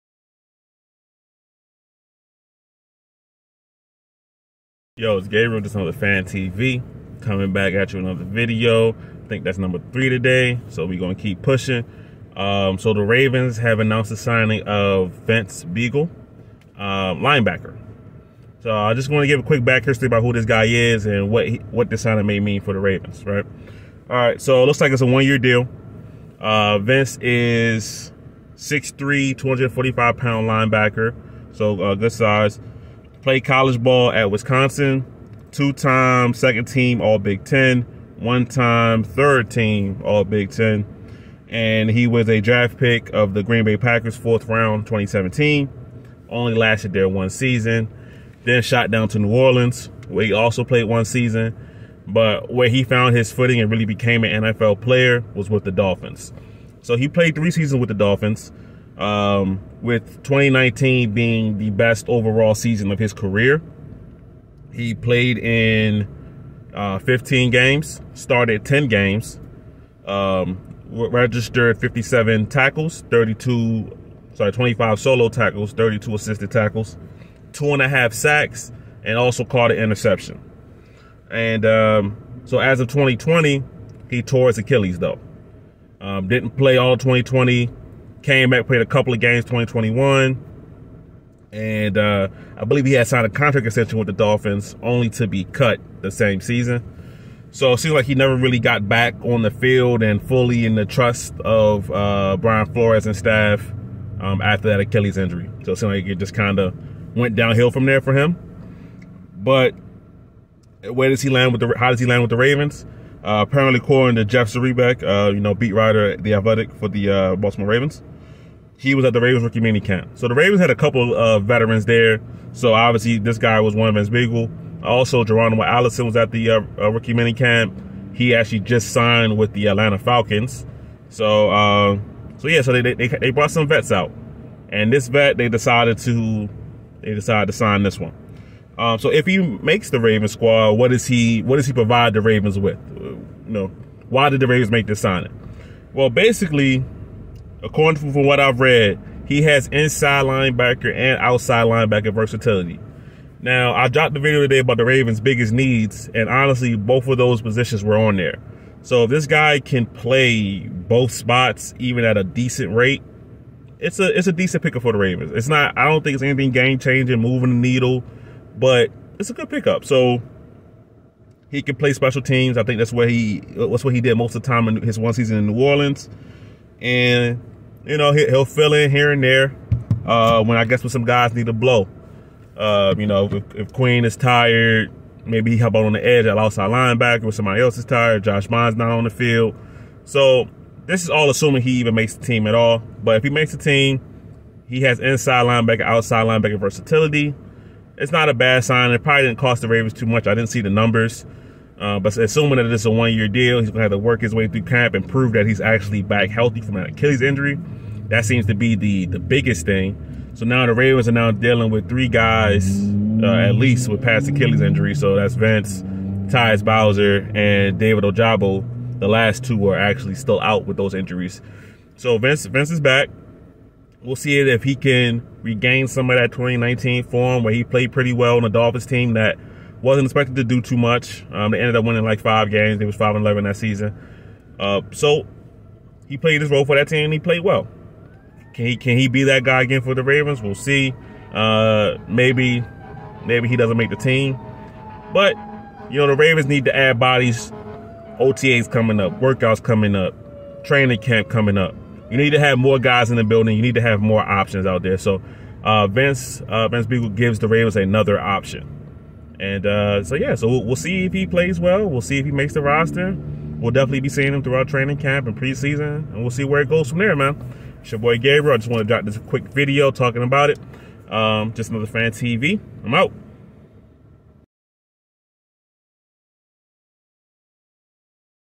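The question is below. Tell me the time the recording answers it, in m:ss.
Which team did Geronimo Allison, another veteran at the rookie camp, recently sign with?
2:09.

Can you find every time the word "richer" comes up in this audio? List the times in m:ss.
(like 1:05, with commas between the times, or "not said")
not said.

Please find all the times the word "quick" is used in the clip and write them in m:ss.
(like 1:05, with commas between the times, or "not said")
0:19, 4:29.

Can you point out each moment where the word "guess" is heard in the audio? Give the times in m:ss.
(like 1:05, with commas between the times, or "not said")
3:00.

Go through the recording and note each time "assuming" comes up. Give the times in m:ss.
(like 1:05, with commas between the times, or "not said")
3:11, 3:22.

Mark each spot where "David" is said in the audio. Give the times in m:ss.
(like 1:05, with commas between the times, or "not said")
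3:37.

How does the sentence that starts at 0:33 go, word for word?
Played college ball at Wisconsin, two time second team All Big Ten, one time third team All Big Ten.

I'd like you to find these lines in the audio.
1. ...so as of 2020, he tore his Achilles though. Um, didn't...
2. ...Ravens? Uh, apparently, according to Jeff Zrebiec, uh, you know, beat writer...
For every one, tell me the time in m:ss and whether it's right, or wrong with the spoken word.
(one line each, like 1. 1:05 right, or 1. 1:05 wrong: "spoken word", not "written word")
1. 1:22 right
2. 1:52 right.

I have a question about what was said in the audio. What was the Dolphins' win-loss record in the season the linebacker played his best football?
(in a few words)
5 and 11.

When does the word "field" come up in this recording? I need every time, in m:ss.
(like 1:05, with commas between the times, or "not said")
1:39, 3:09.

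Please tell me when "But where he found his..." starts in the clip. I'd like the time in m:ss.
0:52.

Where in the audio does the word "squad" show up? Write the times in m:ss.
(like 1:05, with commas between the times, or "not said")
2:20.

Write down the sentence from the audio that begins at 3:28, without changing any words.
That seems to be the the biggest thing.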